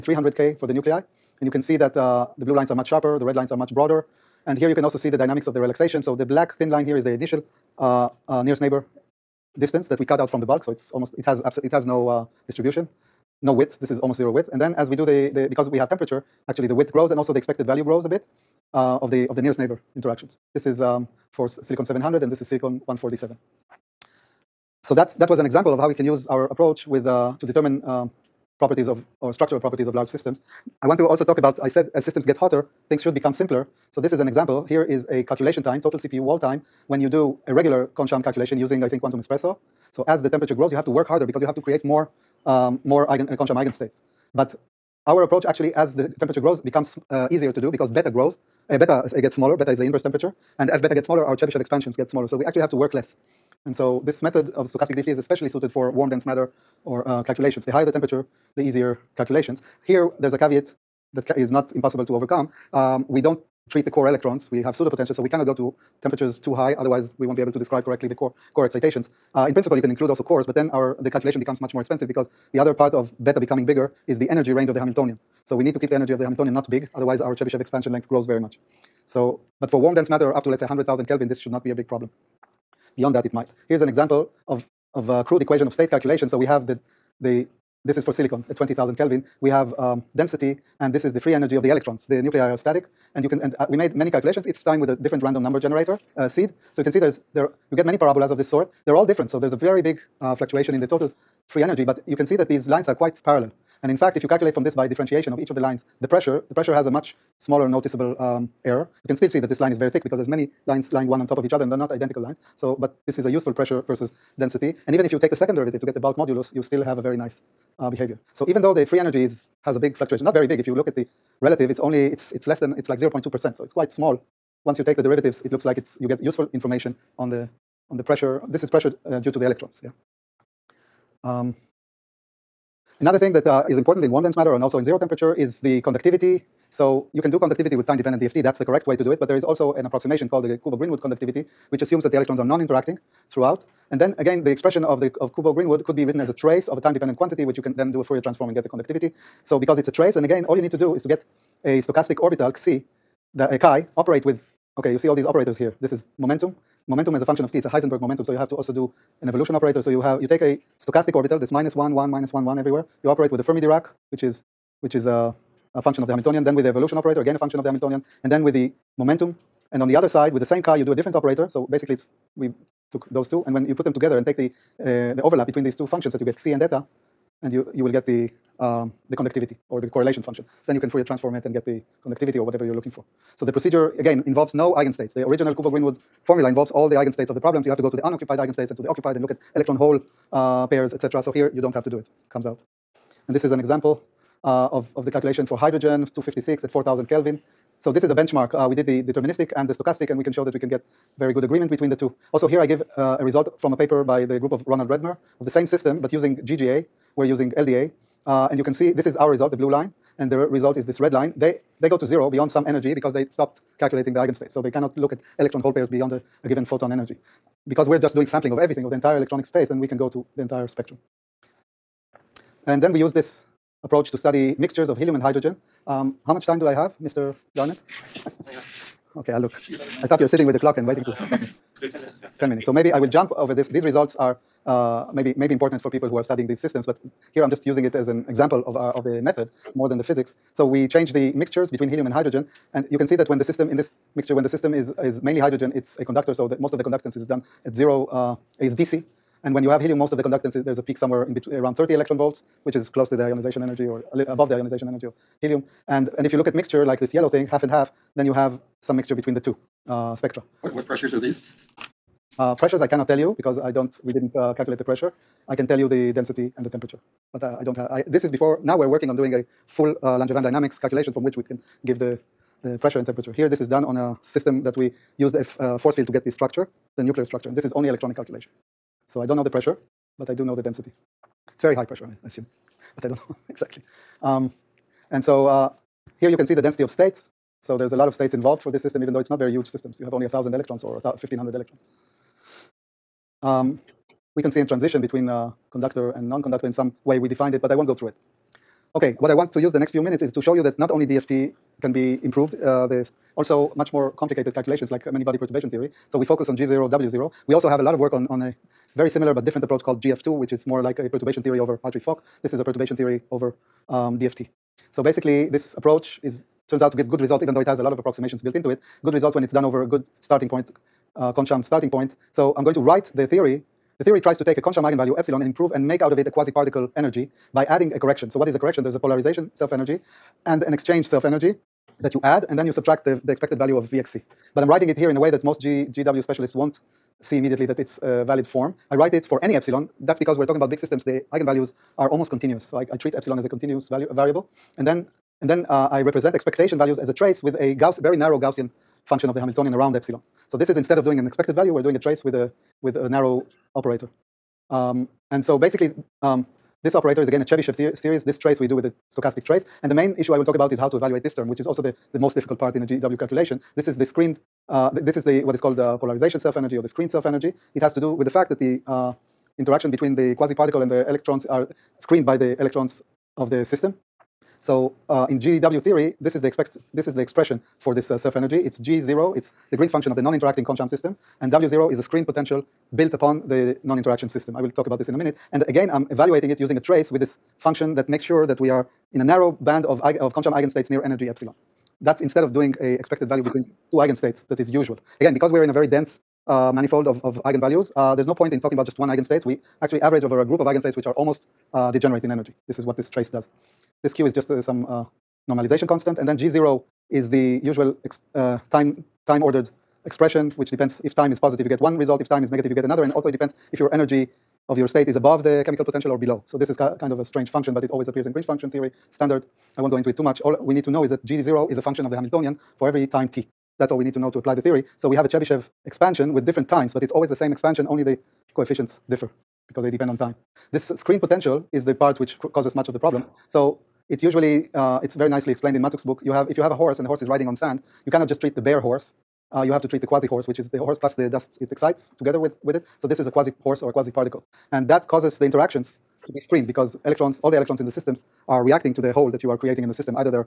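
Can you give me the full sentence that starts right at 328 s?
There's a polarization self-energy and an exchange self-energy that you add, and then you subtract the, the expected value of Vxc.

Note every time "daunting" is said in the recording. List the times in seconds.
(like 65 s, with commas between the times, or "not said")
not said.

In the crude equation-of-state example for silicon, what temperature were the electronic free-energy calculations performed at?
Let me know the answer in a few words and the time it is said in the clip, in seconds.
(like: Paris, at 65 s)
20,000 Kelvin, at 88 s.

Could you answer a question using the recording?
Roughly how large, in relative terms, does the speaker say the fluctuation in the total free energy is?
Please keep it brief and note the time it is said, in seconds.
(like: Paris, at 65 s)
0.2%, at 122 s.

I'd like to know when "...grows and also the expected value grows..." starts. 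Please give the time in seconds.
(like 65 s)
16 s.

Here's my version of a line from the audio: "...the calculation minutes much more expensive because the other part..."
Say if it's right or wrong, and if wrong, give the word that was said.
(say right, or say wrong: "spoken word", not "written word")
wrong: "becomes", not "minutes".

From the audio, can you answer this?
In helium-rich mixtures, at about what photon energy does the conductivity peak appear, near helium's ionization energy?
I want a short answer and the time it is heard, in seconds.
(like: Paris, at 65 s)
30 electron volts, at 251 s.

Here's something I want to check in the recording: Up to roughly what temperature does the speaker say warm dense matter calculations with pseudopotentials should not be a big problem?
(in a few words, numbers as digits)
100,000 Kelvin.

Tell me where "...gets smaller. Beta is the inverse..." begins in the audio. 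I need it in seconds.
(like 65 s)
49 s.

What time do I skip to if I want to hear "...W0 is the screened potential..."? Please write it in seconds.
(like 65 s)
381 s.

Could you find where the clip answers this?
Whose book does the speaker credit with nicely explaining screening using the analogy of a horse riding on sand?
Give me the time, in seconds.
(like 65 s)
435 s.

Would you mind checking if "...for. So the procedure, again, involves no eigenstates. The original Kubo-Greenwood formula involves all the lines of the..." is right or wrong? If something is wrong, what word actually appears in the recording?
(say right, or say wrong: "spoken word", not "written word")
wrong: "eigenstates", not "lines".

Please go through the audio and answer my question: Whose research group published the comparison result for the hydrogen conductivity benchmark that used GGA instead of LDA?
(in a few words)
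Ronald Redmer.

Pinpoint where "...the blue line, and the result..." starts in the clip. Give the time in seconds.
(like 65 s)
209 s.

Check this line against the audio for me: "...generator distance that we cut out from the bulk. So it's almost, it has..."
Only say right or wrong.
wrong.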